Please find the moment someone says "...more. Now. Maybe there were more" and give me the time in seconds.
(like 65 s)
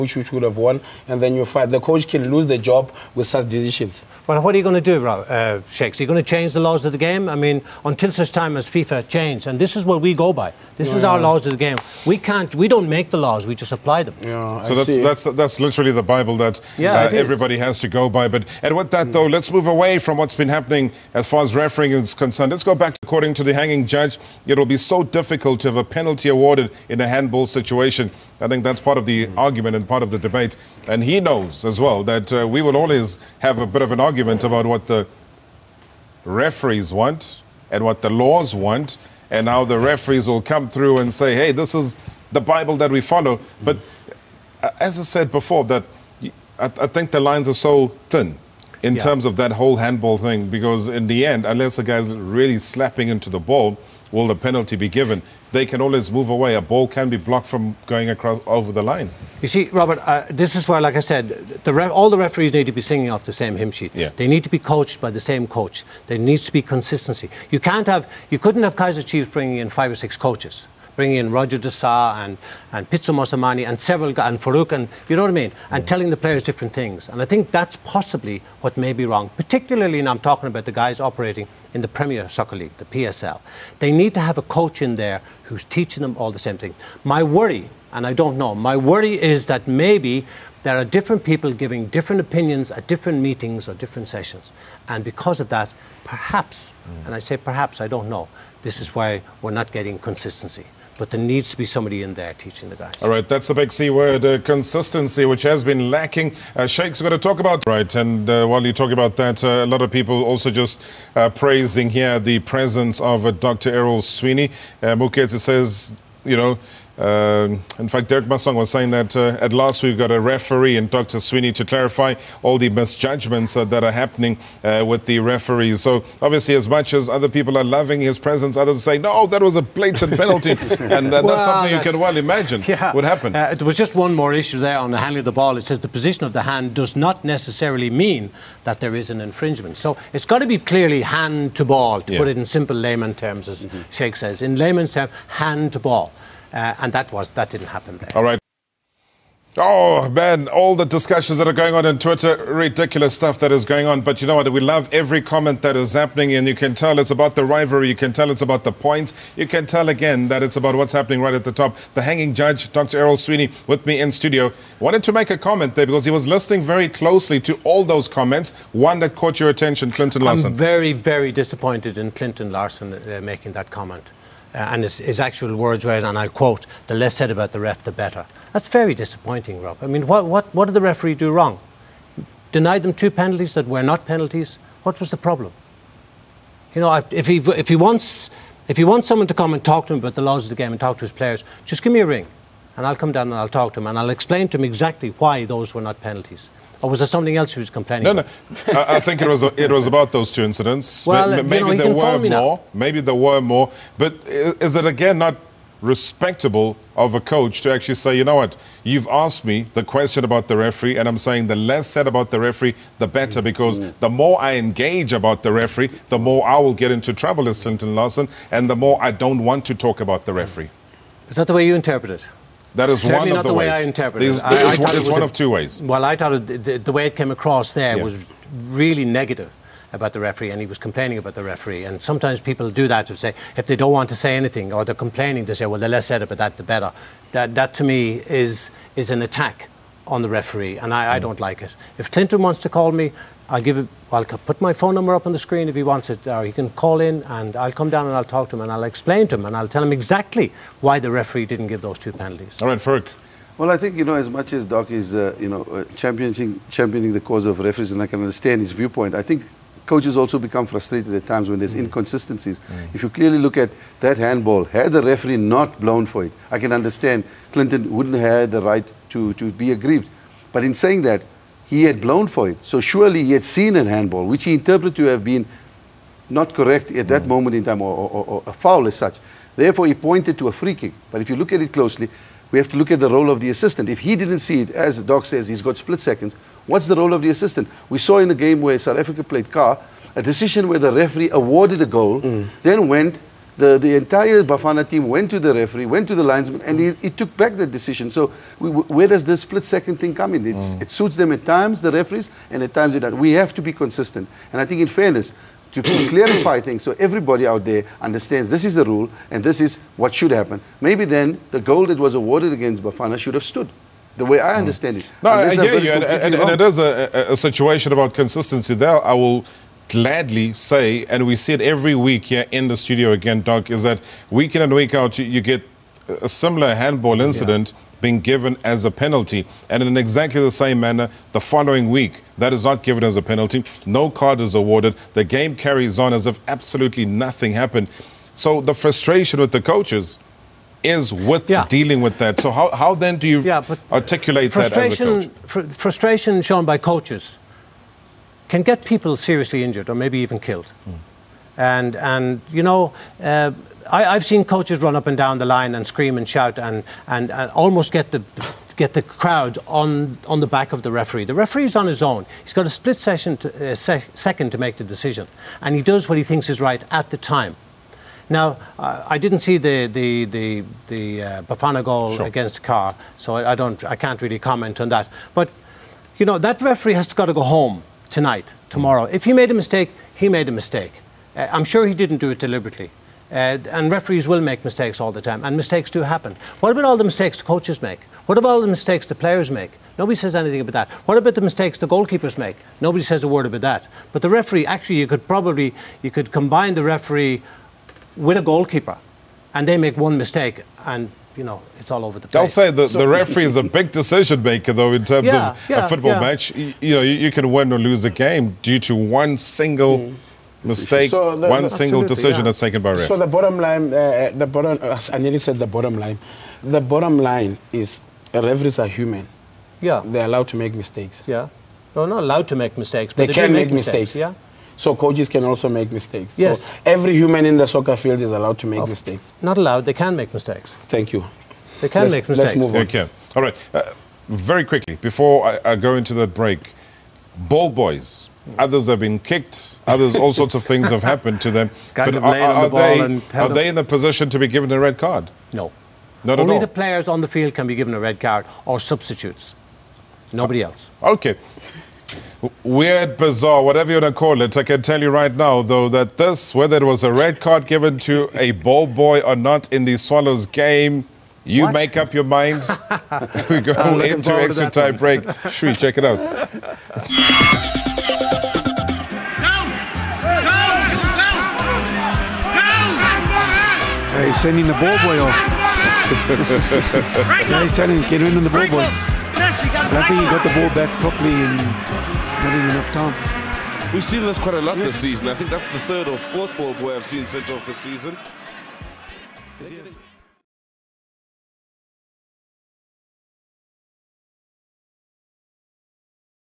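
202 s.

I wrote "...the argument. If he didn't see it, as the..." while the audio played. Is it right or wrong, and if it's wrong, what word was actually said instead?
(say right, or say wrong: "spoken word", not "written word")
wrong: "assistant", not "argument".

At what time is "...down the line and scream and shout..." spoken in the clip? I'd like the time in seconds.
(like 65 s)
355 s.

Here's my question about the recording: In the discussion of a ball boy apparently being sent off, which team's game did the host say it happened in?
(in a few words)
Swallows.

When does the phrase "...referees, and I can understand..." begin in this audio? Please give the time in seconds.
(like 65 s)
257 s.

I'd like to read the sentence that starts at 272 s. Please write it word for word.
So surely he had seen a handball, which he interpreted to have been not correct at that mm.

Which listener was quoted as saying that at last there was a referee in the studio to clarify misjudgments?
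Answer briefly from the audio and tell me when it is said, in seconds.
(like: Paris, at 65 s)
Derek Masong, at 118 s.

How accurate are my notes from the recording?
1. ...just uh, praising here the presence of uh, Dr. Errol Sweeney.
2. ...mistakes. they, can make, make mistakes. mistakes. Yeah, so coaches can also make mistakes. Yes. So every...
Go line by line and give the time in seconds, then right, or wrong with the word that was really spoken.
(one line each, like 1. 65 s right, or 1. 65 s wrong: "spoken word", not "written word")
1. 110 s right
2. 422 s right.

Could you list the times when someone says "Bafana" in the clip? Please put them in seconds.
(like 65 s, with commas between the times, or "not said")
294 s, 312 s, 371 s.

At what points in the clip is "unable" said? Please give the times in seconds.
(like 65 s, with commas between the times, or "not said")
not said.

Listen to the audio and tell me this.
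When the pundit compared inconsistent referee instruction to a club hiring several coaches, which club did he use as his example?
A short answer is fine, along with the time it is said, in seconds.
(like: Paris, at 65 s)
Kaizer Chiefs, at 68 s.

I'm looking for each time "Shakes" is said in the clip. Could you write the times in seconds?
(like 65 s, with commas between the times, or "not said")
5 s, 106 s, 143 s.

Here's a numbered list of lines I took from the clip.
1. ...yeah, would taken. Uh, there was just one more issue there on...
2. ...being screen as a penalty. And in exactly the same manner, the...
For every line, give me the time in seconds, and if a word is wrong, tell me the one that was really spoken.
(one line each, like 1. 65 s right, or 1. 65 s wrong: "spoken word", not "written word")
1. 132 s wrong: "happen", not "taken"
2. 328 s wrong: "given", not "screen".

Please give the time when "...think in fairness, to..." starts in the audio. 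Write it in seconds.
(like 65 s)
304 s.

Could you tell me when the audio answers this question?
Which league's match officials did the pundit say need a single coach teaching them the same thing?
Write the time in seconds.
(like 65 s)
81 s.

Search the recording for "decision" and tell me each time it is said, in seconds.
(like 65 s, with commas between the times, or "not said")
3 s, 290 s, 297 s, 364 s, 403 s, 412 s.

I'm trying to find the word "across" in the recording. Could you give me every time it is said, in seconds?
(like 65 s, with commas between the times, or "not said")
58 s, 227 s.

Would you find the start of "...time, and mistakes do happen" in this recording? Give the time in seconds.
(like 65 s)
385 s.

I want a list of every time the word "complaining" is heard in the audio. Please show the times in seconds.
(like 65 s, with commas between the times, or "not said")
197 s, 230 s, 235 s.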